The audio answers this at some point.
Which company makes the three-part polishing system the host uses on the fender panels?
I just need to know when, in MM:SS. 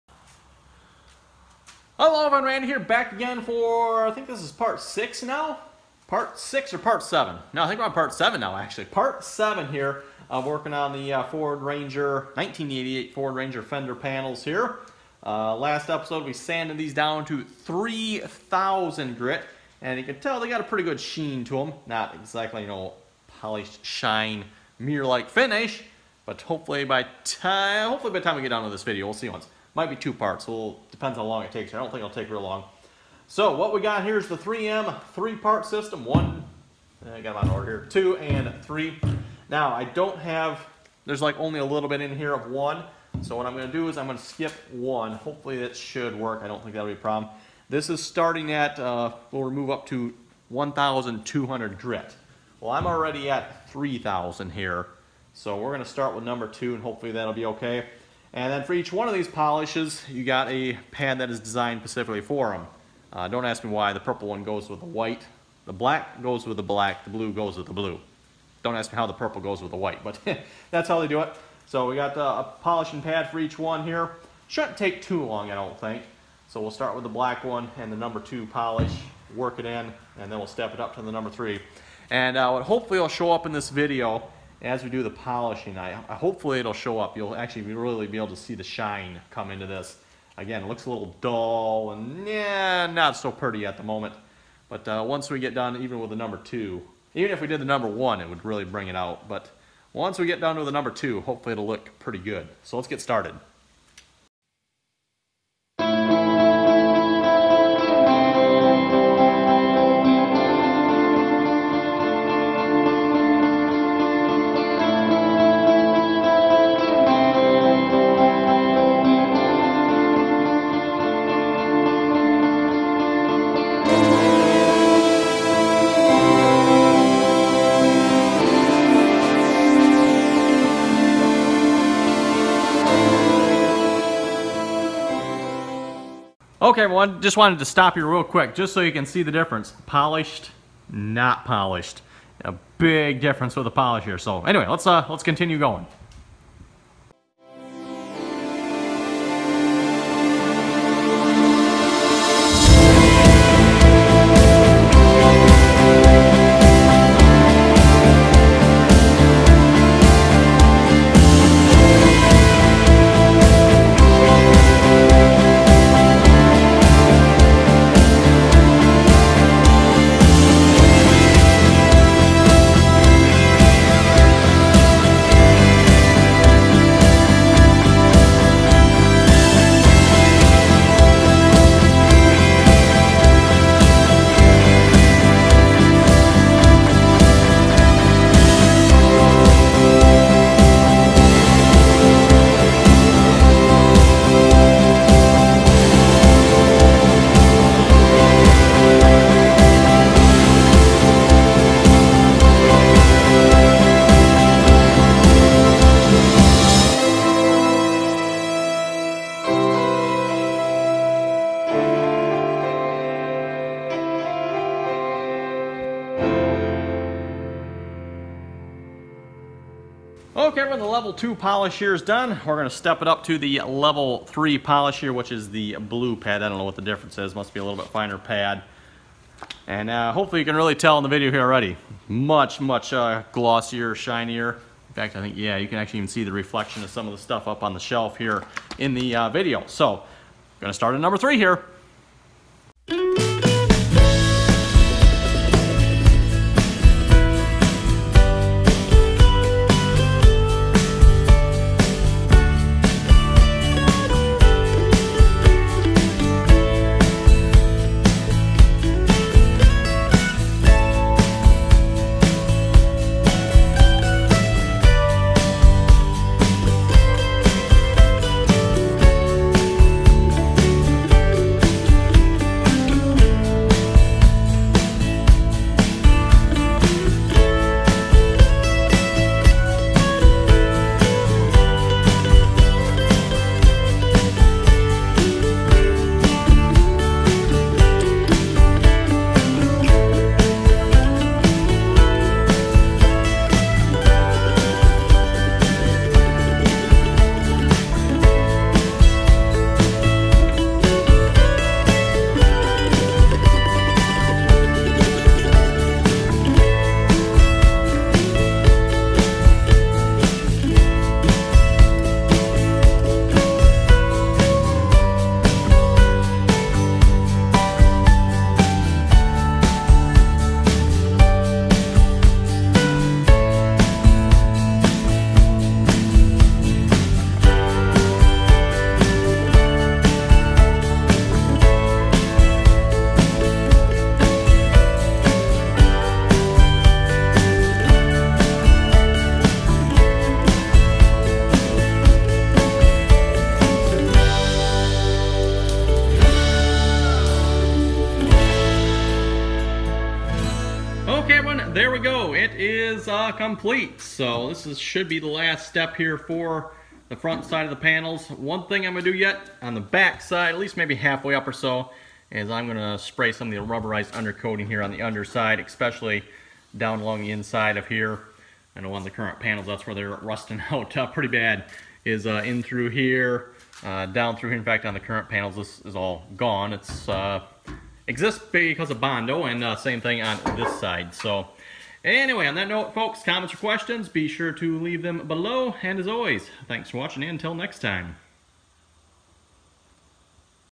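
00:34.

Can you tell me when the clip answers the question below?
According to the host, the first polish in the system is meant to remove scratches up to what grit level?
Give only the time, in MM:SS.
00:50.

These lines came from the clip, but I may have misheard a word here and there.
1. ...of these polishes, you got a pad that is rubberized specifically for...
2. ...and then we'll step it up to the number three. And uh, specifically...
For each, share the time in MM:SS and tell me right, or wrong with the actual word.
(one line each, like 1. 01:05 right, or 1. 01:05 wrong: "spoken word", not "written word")
1. 00:59 wrong: "designed", not "rubberized"
2. 01:20 wrong: "hopefully", not "specifically".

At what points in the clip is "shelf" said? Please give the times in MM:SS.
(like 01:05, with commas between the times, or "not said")
03:57.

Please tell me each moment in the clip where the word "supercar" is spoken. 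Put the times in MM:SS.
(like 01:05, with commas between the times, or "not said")
not said.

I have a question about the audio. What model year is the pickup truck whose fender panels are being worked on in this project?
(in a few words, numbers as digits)
1988.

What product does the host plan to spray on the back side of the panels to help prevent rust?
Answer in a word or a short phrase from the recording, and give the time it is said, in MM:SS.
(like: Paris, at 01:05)
Rubberized undercoating, at 06:03.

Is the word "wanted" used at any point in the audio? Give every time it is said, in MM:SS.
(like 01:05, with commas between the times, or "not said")
02:17.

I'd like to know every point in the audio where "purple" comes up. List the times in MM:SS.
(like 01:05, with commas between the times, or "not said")
01:03, 01:09.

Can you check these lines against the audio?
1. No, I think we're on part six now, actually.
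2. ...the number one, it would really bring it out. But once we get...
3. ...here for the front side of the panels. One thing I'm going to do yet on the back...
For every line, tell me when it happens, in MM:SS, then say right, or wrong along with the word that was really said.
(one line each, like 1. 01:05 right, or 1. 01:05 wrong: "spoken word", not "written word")
1. 00:07 wrong: "seven", not "six"
2. 01:37 right
3. 05:55 right.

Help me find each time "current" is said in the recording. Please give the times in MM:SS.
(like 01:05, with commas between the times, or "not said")
06:09, 06:14.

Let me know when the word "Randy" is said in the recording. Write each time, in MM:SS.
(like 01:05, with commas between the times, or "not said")
00:02.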